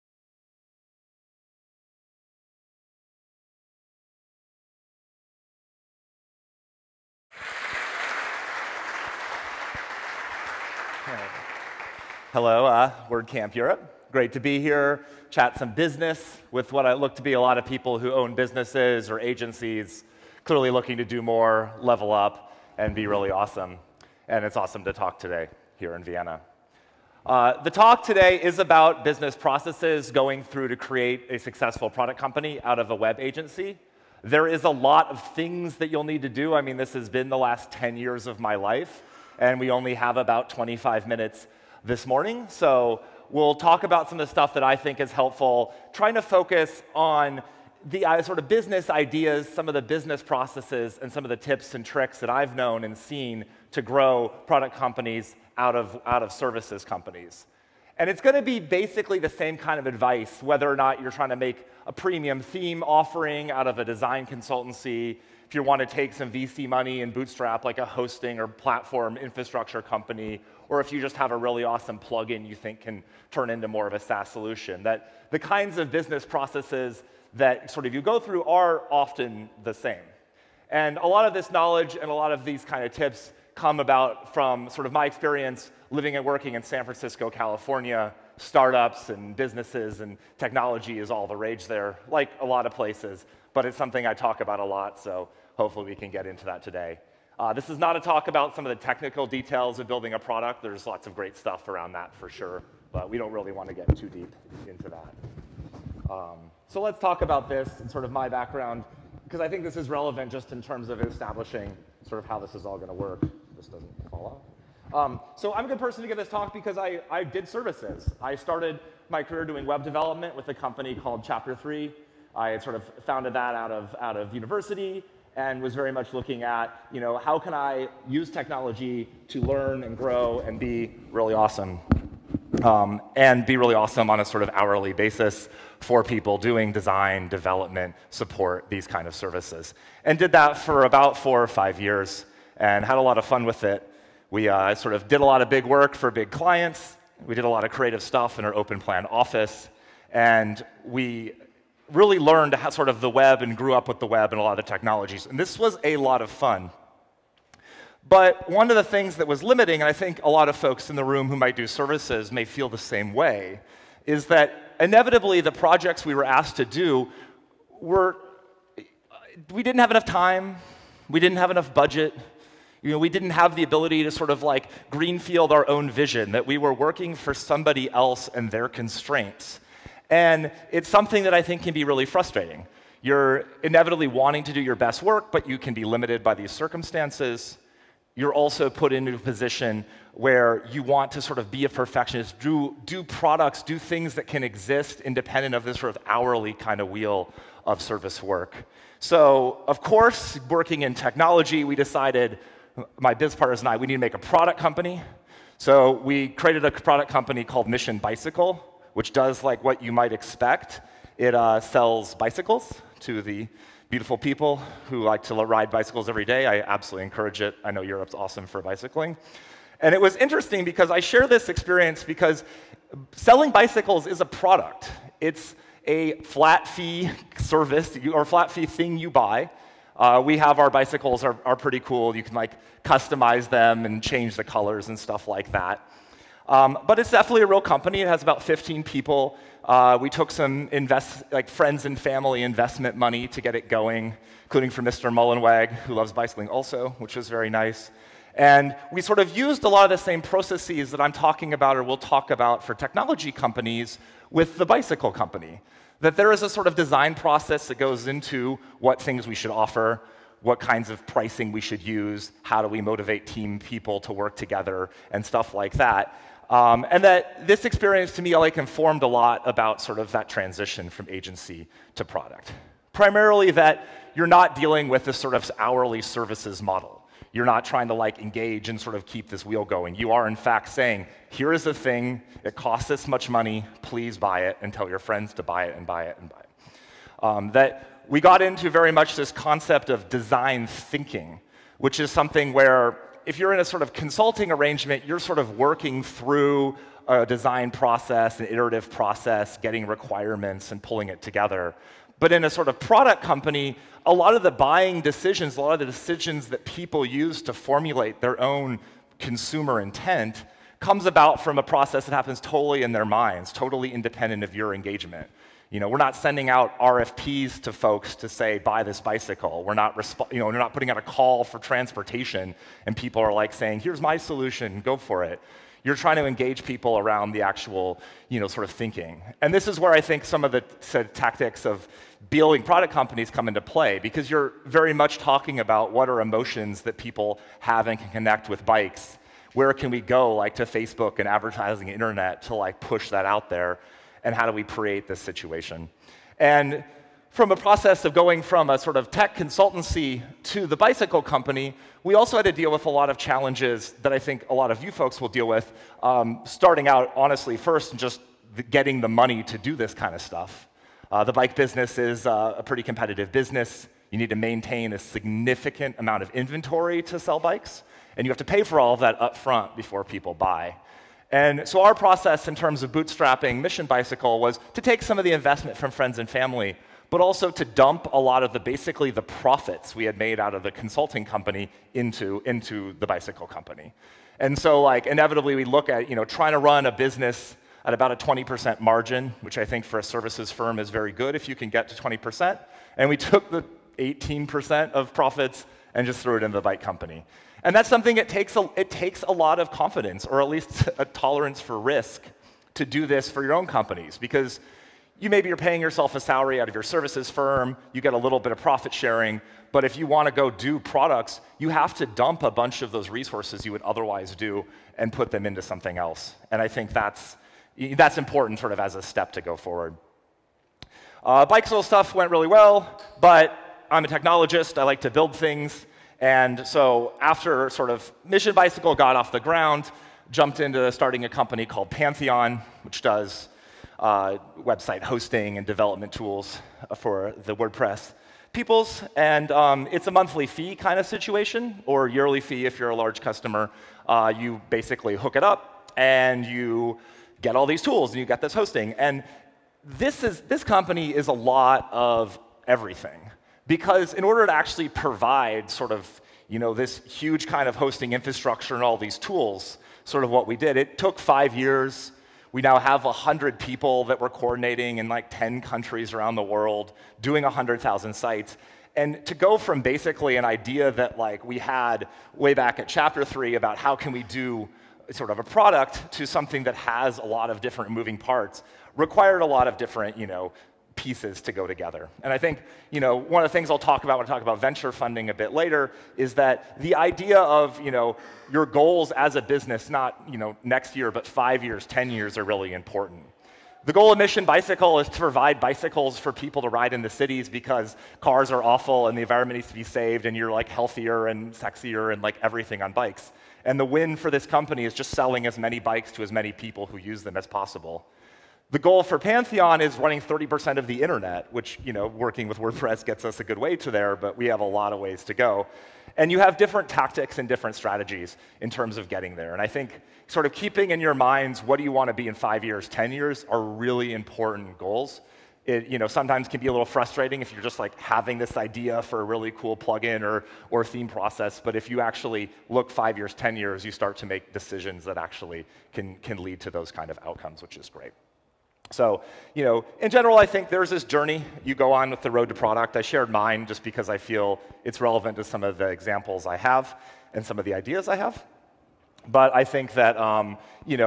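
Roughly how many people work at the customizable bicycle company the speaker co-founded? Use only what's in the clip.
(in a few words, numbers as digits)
15.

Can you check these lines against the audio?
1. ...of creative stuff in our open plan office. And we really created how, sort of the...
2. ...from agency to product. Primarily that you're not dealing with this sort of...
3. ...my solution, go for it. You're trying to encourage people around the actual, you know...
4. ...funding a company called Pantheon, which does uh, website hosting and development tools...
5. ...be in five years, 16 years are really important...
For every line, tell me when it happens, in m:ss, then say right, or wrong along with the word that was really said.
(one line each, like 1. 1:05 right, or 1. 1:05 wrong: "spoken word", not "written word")
1. 2:27 wrong: "learned", not "created"
2. 4:30 right
3. 5:24 wrong: "engage", not "encourage"
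4. 7:10 wrong: "starting", not "funding"
5. 8:42 wrong: "10", not "16".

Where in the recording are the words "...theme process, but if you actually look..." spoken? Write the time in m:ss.
8:50.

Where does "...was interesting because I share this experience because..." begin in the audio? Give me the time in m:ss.
3:40.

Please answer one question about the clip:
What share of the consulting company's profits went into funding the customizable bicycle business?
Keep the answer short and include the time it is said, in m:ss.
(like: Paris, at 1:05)
18%, at 6:33.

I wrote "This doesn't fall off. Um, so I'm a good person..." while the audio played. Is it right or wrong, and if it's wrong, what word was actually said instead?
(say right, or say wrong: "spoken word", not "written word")
right.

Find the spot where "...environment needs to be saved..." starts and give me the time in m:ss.
8:19.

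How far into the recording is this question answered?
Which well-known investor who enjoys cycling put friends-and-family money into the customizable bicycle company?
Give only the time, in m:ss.
4:04.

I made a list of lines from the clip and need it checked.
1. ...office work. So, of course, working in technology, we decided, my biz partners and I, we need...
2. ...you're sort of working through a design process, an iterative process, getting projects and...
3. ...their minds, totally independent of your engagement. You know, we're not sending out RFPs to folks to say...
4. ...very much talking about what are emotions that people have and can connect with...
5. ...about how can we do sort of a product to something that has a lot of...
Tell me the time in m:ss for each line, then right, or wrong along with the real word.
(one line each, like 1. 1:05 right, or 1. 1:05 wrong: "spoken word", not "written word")
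1. 3:17 wrong: "service", not "office"
2. 4:55 wrong: "requirements", not "projects"
3. 5:12 right
4. 5:34 right
5. 7:53 right.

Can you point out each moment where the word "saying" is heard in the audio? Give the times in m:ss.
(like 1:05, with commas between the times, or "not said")
4:40, 5:23.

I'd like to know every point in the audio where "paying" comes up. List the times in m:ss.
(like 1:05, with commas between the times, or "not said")
6:45.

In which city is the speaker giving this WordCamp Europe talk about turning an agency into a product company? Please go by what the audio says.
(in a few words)
Vienna.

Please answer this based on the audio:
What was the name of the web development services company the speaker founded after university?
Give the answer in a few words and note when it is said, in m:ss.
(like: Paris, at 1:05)
Chapter 3, at 2:01.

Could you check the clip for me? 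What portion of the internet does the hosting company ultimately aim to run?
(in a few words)
30%.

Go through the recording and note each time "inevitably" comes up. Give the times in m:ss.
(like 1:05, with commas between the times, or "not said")
2:44, 3:03, 6:25.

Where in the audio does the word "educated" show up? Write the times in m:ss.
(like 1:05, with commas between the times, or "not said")
not said.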